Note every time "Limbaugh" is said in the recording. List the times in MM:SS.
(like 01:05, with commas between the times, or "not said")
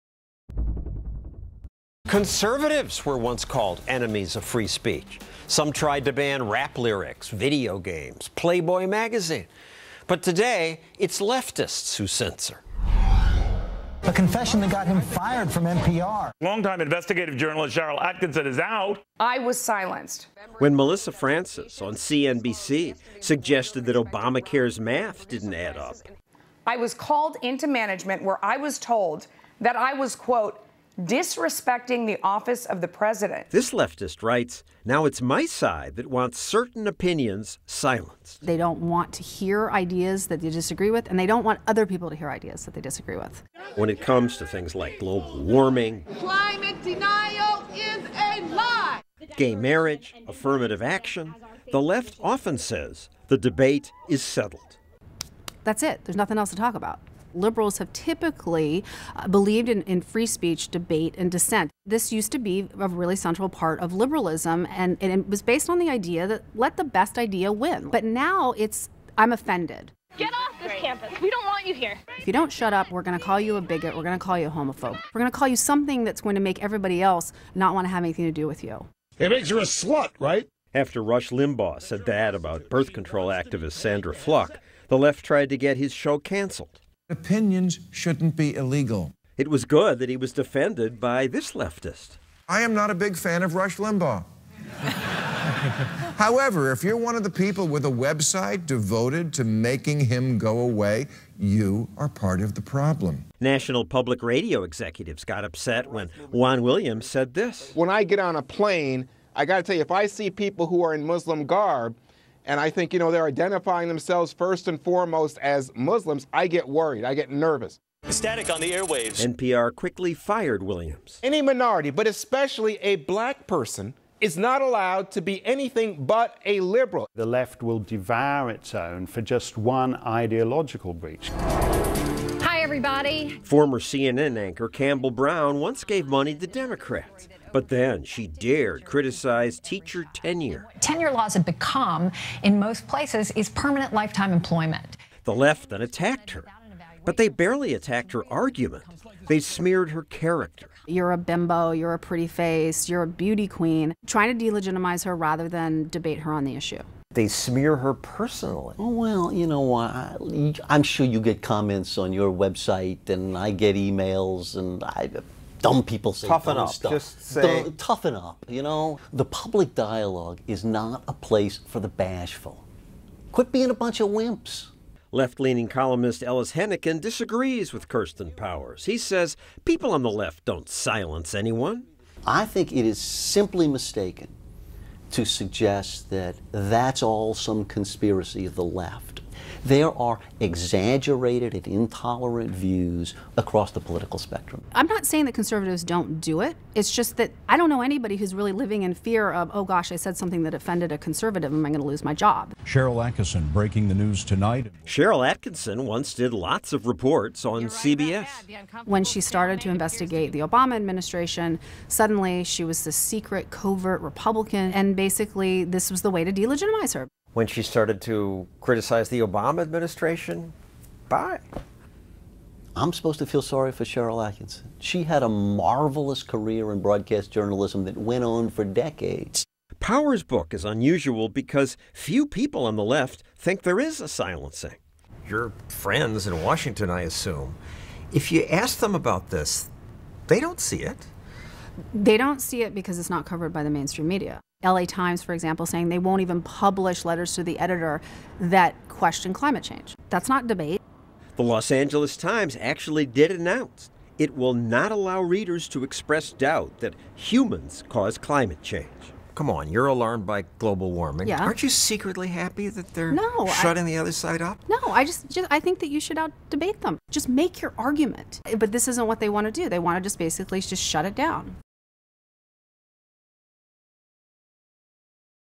01:21, 01:33.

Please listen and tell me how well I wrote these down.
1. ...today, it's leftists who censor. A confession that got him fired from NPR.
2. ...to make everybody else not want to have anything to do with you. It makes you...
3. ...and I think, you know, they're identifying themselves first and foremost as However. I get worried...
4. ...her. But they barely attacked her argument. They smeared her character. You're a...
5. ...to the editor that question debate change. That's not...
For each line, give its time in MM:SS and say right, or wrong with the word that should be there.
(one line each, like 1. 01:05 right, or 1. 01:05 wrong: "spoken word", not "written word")
1. 00:10 right
2. 01:16 right
3. 01:52 wrong: "Muslims", not "However"
4. 02:26 right
5. 04:07 wrong: "climate", not "debate".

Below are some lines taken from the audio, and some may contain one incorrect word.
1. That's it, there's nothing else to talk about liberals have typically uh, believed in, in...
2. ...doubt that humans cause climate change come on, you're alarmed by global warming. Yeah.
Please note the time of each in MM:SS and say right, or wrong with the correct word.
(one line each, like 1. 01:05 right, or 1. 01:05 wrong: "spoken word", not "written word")
1. 00:55 right
2. 04:16 right.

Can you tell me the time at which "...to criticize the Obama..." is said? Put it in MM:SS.
03:38.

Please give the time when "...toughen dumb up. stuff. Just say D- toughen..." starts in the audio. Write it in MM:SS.
02:46.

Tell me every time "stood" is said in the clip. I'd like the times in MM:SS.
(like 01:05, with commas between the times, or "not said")
not said.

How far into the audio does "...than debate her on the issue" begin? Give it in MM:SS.
02:35.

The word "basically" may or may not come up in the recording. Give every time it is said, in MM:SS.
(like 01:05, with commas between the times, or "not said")
03:34, 04:30.